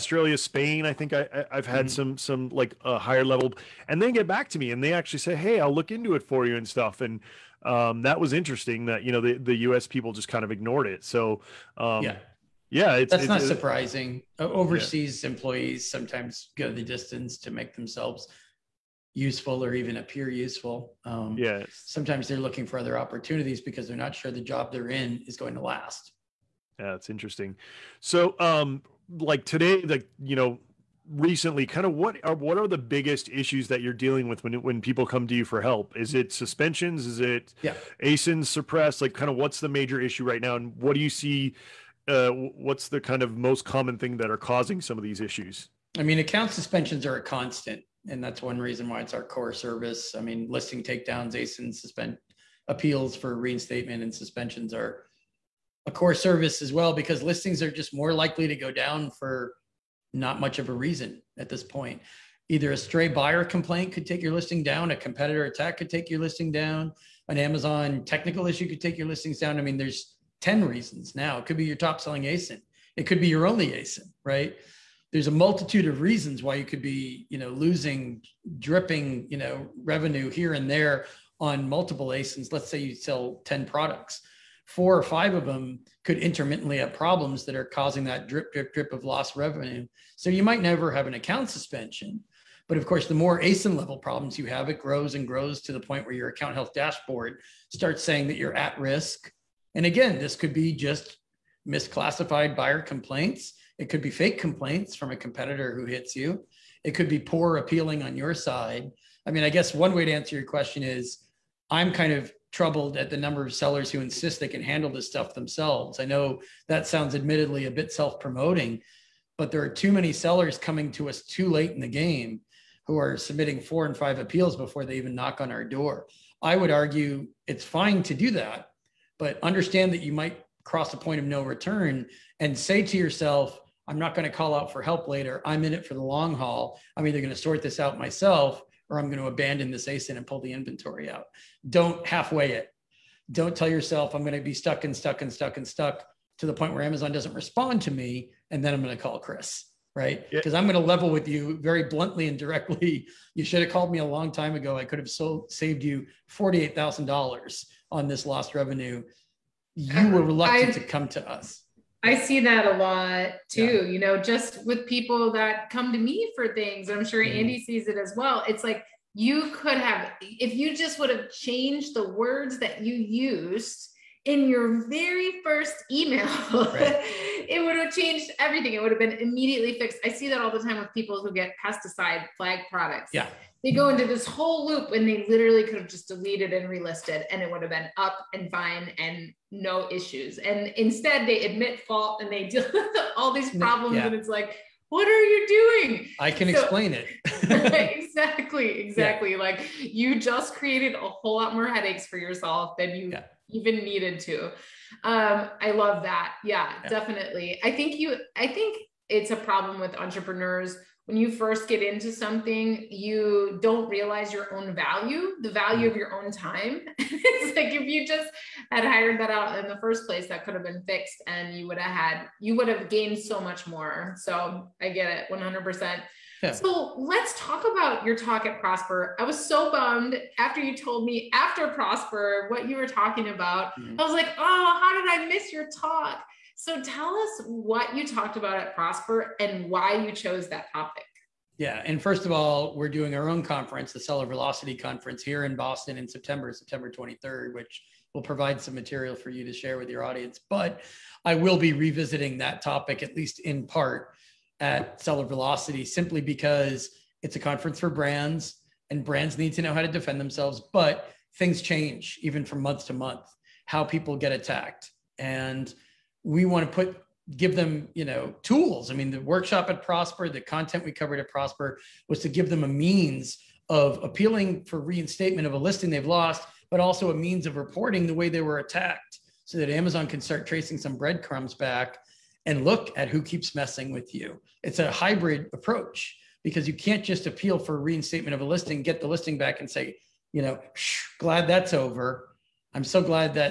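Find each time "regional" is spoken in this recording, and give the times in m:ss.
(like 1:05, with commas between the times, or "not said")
not said.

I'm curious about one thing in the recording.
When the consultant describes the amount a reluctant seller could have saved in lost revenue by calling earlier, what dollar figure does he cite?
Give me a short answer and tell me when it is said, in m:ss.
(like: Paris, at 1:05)
$48,000, at 2:36.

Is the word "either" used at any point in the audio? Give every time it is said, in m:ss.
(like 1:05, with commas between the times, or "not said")
1:02, 2:17.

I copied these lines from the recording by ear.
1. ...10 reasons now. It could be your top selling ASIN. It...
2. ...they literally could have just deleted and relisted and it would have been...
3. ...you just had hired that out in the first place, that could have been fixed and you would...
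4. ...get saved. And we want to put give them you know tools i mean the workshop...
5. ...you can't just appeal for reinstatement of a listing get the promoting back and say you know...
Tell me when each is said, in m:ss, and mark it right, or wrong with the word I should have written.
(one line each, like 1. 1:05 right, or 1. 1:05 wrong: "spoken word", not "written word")
1. 1:10 right
2. 3:05 right
3. 3:37 right
4. 4:24 wrong: "attacked", not "saved"
5. 4:46 wrong: "listing", not "promoting".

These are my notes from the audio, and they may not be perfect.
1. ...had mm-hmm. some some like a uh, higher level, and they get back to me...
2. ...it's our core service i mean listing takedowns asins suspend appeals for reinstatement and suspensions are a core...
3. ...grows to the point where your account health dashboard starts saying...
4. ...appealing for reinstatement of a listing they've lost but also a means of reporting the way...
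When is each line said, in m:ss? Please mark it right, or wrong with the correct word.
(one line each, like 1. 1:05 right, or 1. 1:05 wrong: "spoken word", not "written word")
1. 0:01 right
2. 0:49 right
3. 1:35 right
4. 4:34 right.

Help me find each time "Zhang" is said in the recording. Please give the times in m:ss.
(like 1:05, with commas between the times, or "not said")
not said.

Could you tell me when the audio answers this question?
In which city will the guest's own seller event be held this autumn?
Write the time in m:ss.
4:05.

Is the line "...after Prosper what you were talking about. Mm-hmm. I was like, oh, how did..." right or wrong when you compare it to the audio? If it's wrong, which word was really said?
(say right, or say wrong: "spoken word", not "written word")
right.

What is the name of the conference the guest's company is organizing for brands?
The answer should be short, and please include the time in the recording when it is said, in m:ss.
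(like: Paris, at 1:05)
Seller Velocity Conference, at 4:03.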